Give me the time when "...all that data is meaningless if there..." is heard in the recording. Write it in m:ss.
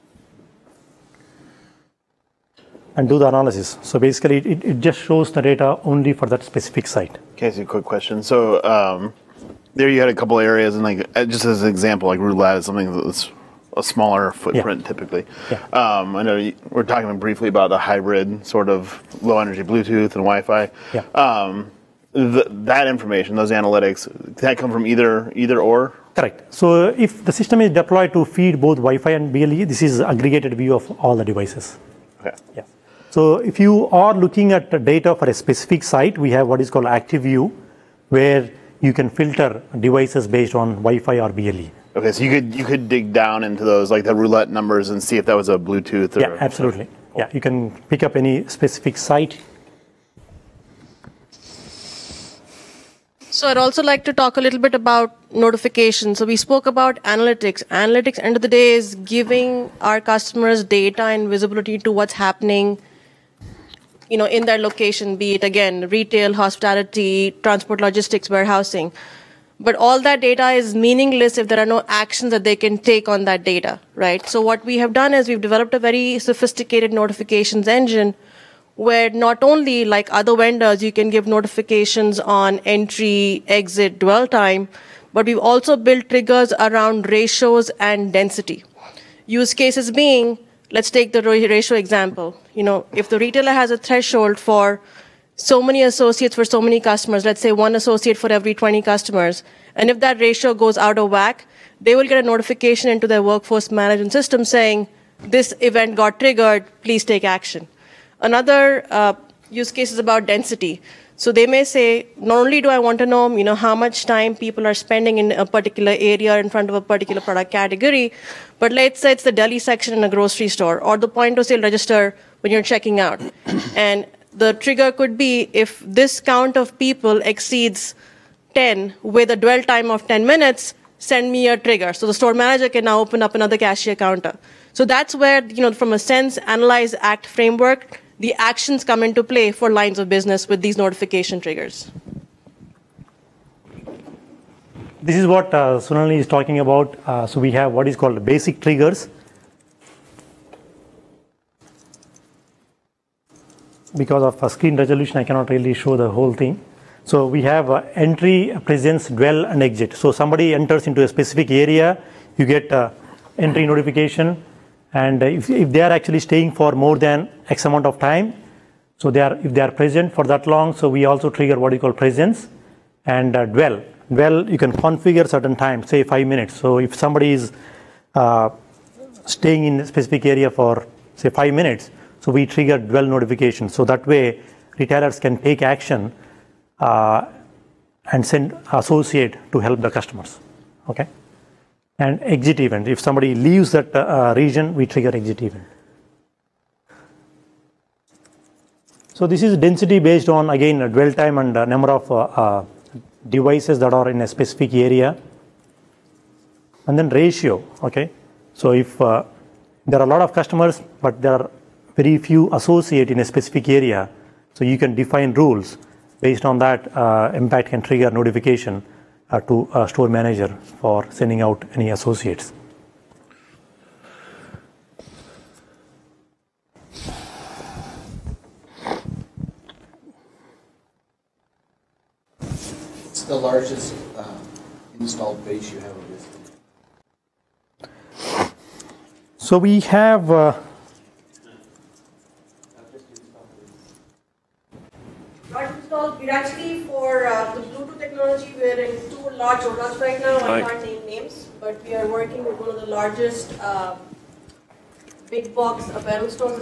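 1:09.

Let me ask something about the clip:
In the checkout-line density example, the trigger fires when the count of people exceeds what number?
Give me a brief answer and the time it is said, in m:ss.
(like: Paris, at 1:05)
10, at 2:07.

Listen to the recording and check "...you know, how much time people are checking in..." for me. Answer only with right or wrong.
wrong.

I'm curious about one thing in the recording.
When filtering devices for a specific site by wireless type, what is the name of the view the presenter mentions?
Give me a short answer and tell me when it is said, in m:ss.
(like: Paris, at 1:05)
Active View, at 0:36.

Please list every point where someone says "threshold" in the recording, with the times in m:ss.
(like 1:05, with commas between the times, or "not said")
1:33.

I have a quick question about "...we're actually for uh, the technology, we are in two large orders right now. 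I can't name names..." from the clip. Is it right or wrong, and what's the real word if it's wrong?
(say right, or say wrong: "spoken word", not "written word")
right.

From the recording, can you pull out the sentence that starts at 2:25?
This is what uh, Sunali is talking about.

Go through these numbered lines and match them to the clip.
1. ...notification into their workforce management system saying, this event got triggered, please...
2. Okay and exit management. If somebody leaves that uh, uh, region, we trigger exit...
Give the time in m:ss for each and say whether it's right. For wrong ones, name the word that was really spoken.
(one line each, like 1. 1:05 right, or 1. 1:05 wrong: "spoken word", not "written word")
1. 1:42 right
2. 3:10 wrong: "event", not "management".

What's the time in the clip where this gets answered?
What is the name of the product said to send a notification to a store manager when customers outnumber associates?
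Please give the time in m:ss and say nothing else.
3:36.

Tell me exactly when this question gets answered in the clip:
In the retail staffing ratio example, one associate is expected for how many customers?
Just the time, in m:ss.
1:38.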